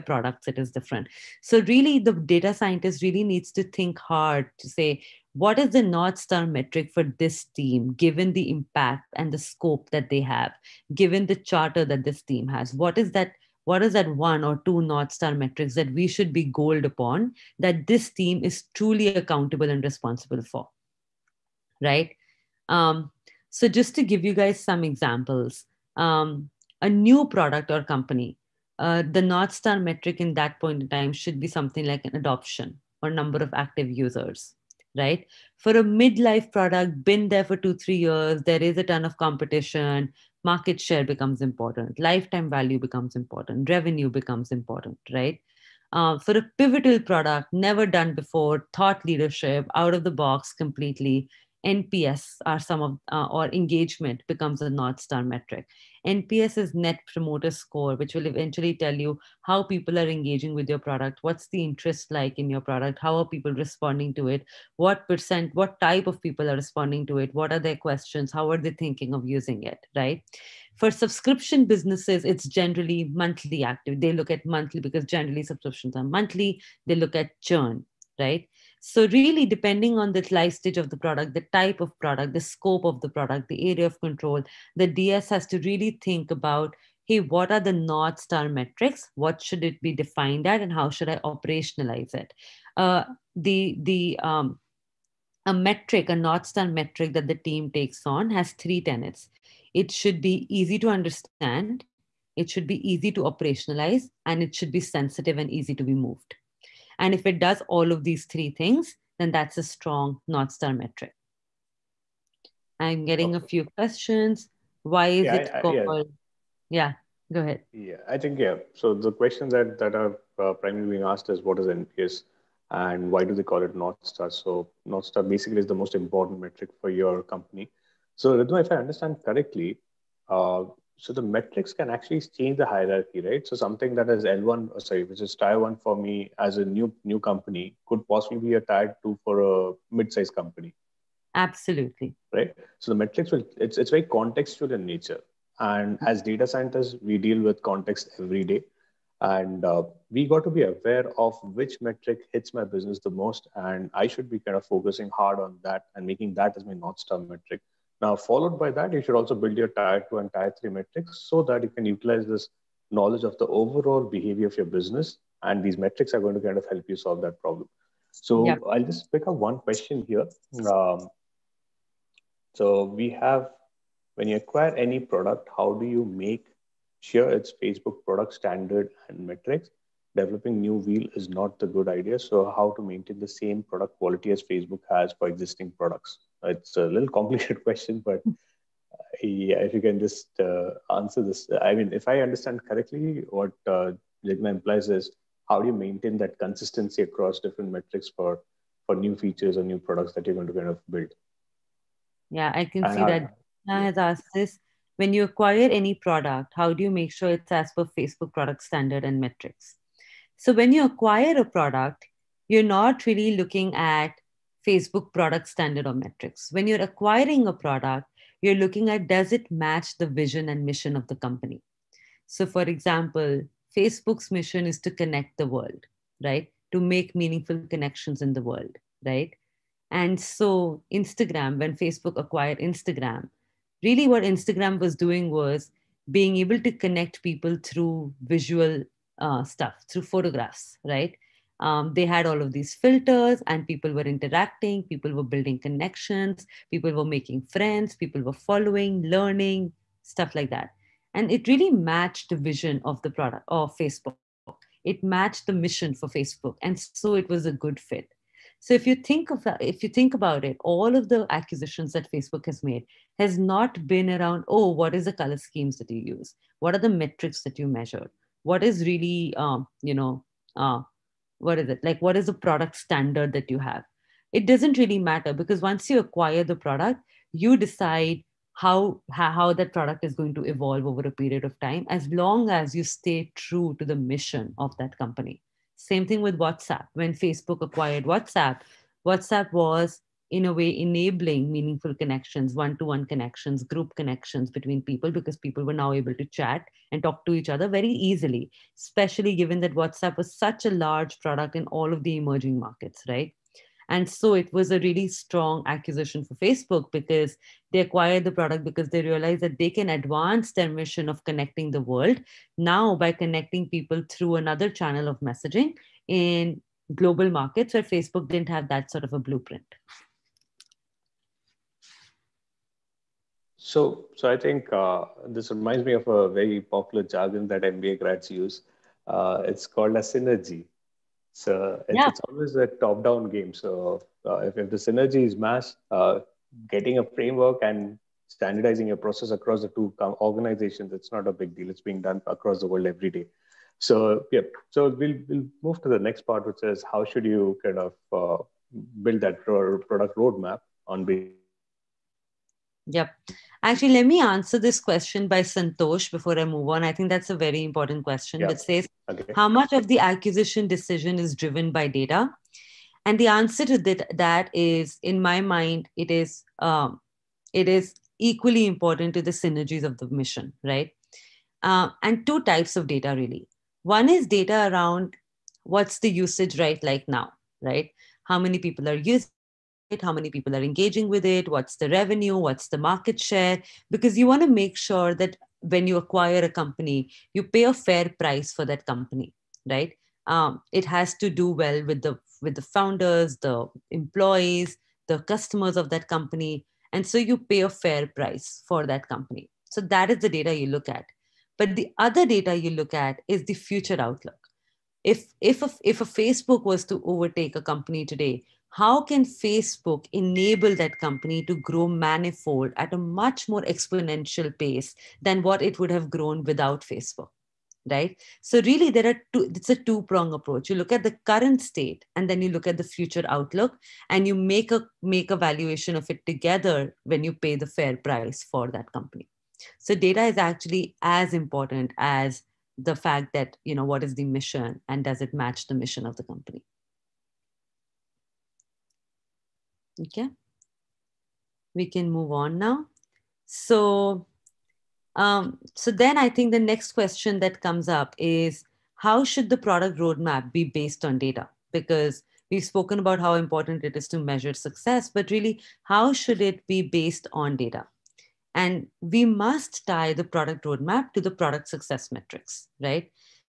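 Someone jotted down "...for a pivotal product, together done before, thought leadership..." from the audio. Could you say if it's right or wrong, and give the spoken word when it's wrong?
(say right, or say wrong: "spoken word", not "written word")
wrong: "never", not "together".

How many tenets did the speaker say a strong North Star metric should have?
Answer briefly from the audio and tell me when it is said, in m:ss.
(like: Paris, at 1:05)
3, at 1:38.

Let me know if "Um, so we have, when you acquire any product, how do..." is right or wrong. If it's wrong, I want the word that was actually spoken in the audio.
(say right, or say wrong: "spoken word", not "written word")
right.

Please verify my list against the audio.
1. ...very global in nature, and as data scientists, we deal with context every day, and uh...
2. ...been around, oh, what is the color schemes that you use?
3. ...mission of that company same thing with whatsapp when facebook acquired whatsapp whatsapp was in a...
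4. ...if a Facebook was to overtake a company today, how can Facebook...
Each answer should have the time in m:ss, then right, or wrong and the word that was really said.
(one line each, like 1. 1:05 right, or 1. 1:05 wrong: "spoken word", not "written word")
1. 2:23 wrong: "contextual", not "global"
2. 4:23 right
3. 4:44 right
4. 6:45 right.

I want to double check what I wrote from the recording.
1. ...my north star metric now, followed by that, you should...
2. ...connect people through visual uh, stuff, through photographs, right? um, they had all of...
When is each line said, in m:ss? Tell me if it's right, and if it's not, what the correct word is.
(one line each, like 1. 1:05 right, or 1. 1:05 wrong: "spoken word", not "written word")
1. 2:36 right
2. 3:56 right.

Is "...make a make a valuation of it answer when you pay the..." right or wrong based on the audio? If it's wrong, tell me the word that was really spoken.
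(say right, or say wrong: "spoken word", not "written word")
wrong: "together", not "answer".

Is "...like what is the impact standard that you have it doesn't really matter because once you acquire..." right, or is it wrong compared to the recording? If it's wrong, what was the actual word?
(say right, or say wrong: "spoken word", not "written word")
wrong: "product", not "impact".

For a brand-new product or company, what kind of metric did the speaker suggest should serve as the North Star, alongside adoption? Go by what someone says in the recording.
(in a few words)
number of active users.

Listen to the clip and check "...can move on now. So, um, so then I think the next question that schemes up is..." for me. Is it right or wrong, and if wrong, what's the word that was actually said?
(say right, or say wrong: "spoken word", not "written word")
wrong: "comes", not "schemes".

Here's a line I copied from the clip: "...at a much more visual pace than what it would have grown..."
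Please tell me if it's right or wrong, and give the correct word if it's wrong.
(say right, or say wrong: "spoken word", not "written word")
wrong: "exponential", not "visual".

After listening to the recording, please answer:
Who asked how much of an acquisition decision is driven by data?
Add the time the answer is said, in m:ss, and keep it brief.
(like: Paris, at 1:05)
Santosh, at 5:55.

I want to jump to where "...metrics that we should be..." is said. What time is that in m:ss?
0:15.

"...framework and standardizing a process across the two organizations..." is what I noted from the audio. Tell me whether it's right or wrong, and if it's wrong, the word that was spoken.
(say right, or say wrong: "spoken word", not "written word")
right.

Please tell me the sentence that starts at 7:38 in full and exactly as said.
And we must tie the product roadmap to the product success metrics, right?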